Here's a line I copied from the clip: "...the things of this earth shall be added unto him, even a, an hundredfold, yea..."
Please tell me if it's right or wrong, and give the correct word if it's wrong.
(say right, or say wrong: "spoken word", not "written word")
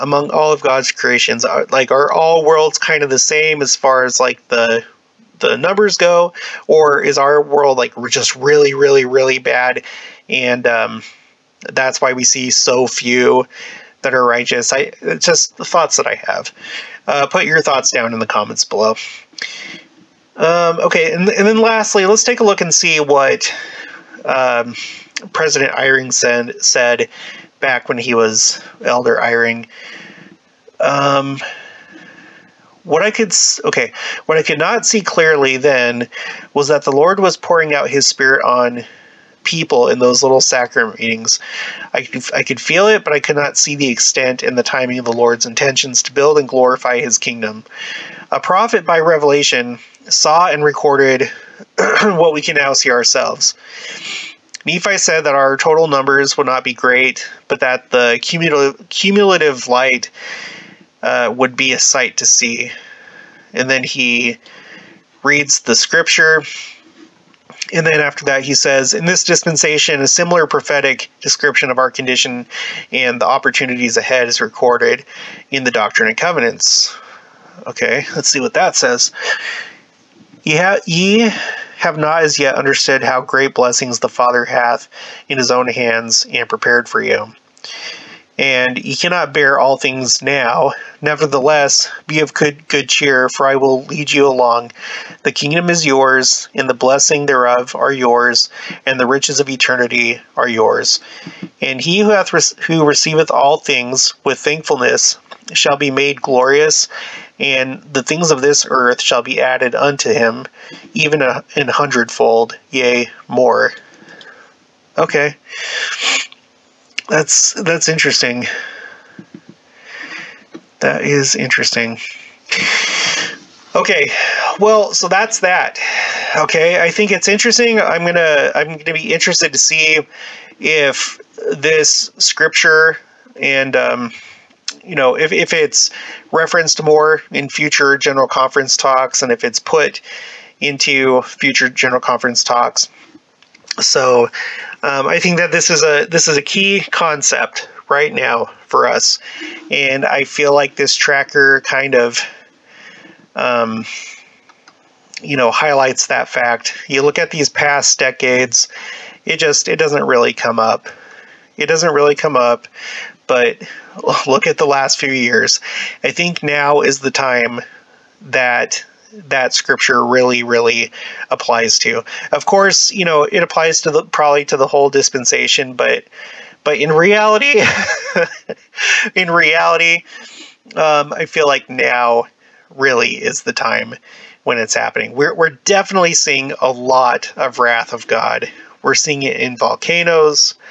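right.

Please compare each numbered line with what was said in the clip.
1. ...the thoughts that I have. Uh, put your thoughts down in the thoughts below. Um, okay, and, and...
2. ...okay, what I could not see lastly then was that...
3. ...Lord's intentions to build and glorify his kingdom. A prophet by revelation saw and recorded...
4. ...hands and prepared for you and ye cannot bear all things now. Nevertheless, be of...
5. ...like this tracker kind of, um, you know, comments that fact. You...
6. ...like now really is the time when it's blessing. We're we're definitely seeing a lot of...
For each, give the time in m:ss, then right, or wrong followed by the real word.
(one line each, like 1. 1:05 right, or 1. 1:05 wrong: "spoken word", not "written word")
1. 0:15 wrong: "comments", not "thoughts"
2. 0:33 wrong: "clearly", not "lastly"
3. 0:45 right
4. 1:25 right
5. 2:30 wrong: "highlights", not "comments"
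6. 3:01 wrong: "happening", not "blessing".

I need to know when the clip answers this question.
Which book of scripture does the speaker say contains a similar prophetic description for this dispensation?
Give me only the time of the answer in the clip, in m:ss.
1:15.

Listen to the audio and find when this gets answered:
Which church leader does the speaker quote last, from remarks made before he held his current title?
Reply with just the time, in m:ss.
0:25.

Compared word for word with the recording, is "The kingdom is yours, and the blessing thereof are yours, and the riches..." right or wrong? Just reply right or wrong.
right.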